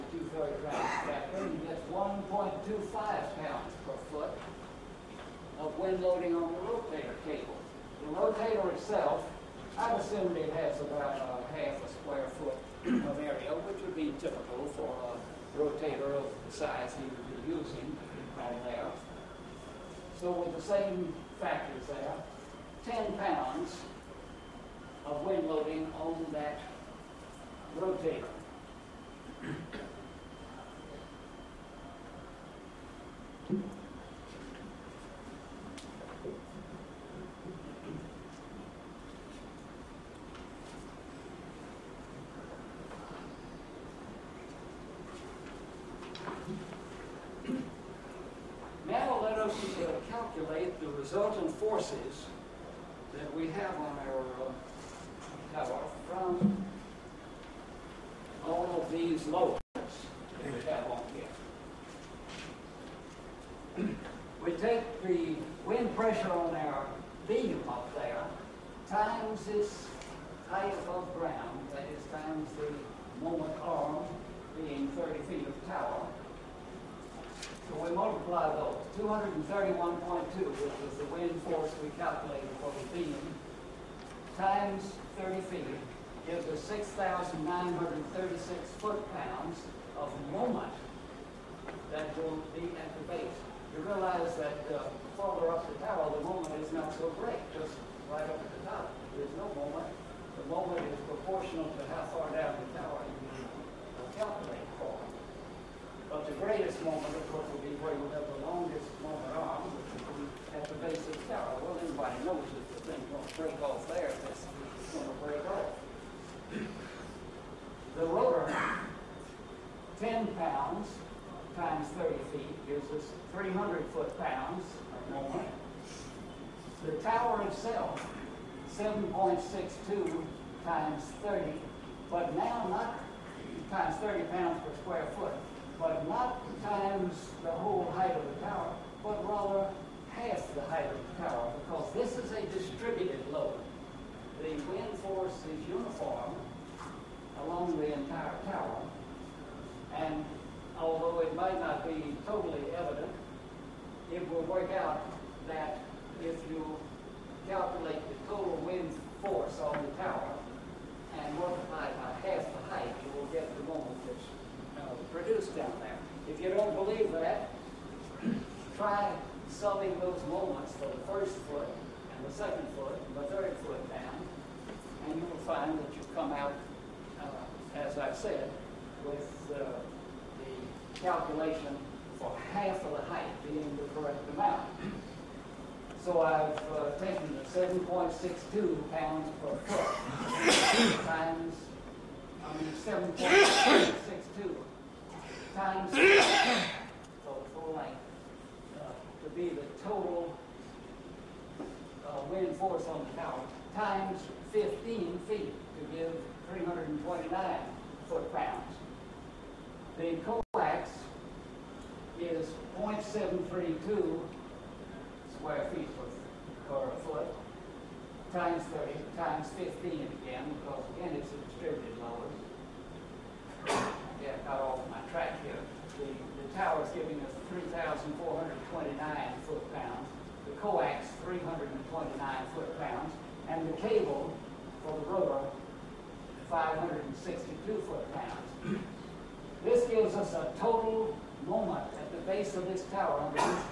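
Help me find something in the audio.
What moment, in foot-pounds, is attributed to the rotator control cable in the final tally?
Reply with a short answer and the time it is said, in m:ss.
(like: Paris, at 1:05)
562, at 3:56.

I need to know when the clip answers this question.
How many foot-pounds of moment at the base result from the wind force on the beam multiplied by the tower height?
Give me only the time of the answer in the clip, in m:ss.
1:26.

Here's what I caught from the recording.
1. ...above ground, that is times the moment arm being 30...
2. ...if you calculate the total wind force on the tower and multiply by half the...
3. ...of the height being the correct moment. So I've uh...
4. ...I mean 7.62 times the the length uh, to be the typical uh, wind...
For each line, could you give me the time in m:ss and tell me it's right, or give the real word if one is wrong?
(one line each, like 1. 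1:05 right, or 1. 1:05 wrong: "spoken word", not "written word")
1. 1:10 right
2. 2:36 right
3. 3:02 wrong: "amount", not "moment"
4. 3:12 wrong: "total", not "typical".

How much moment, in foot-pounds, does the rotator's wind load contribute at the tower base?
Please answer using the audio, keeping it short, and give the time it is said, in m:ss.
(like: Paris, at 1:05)
300, at 2:03.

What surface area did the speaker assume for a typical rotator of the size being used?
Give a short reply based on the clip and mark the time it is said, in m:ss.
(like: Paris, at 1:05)
half a square foot, at 0:11.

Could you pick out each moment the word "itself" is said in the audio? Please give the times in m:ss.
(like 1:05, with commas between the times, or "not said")
0:08, 2:07.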